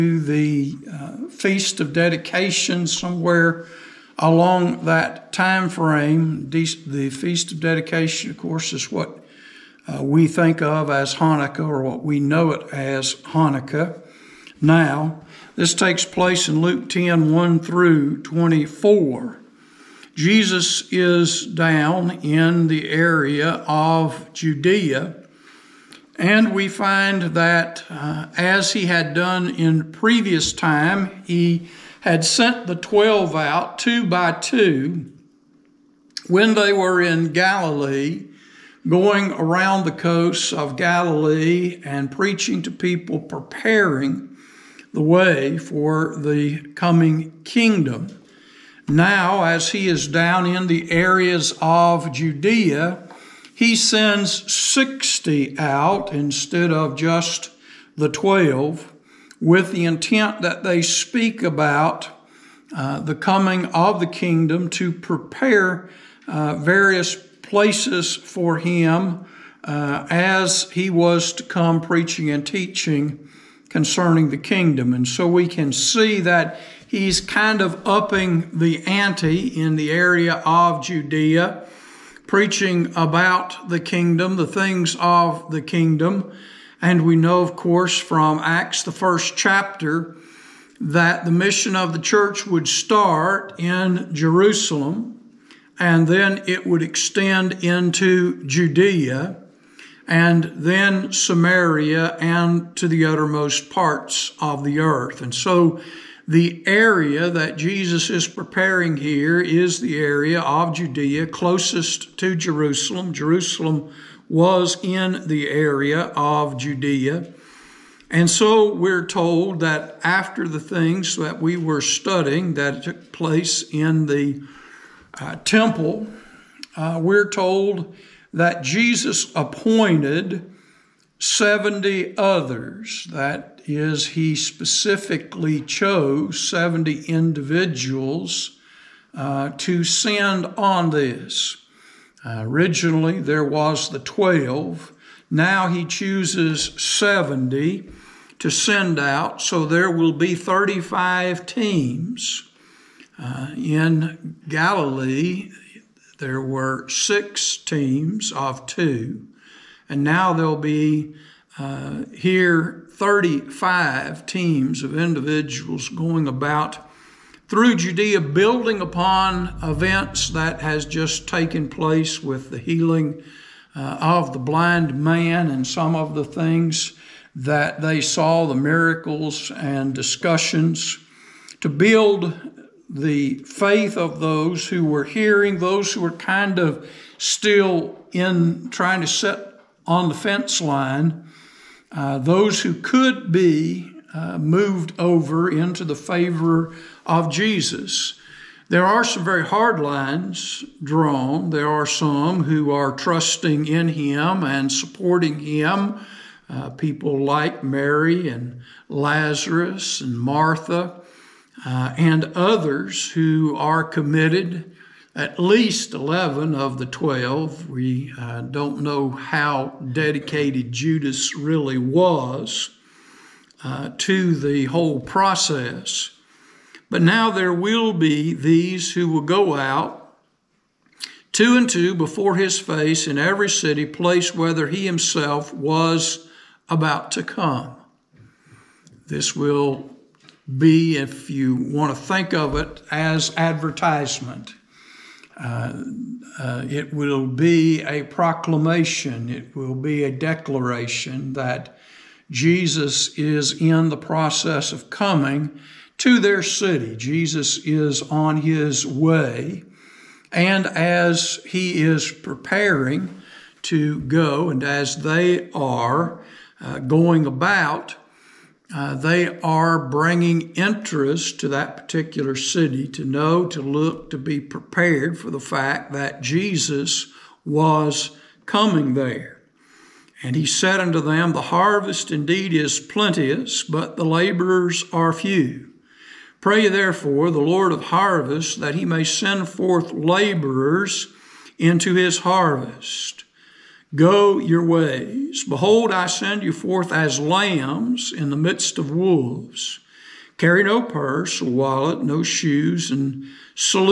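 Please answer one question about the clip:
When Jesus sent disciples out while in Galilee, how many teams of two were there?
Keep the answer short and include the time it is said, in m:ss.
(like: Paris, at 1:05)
6, at 2:36.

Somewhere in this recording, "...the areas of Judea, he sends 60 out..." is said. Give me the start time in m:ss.
0:50.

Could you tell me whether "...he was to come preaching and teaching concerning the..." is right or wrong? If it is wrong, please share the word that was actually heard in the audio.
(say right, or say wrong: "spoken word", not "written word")
right.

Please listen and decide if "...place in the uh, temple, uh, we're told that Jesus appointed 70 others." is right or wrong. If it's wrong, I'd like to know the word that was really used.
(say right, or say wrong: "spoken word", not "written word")
right.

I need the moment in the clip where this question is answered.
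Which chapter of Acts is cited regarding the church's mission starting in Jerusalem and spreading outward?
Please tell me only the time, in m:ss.
1:28.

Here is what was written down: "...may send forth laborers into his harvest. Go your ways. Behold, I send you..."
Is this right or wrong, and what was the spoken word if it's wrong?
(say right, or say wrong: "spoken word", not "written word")
right.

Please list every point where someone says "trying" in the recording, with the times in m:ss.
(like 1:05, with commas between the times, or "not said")
3:08.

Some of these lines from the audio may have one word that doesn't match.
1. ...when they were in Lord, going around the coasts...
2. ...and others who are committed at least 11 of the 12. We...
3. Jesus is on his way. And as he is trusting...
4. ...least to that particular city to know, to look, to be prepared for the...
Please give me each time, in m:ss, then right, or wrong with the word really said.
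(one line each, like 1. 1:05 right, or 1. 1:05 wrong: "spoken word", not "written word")
1. 0:36 wrong: "Galilee", not "Lord"
2. 3:31 right
3. 4:16 wrong: "preparing", not "trusting"
4. 4:30 wrong: "interest", not "least".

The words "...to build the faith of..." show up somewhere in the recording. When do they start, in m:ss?
3:01.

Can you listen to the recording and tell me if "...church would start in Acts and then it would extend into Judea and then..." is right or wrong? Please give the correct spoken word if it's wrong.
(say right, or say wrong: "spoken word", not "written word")
wrong: "Jerusalem", not "Acts".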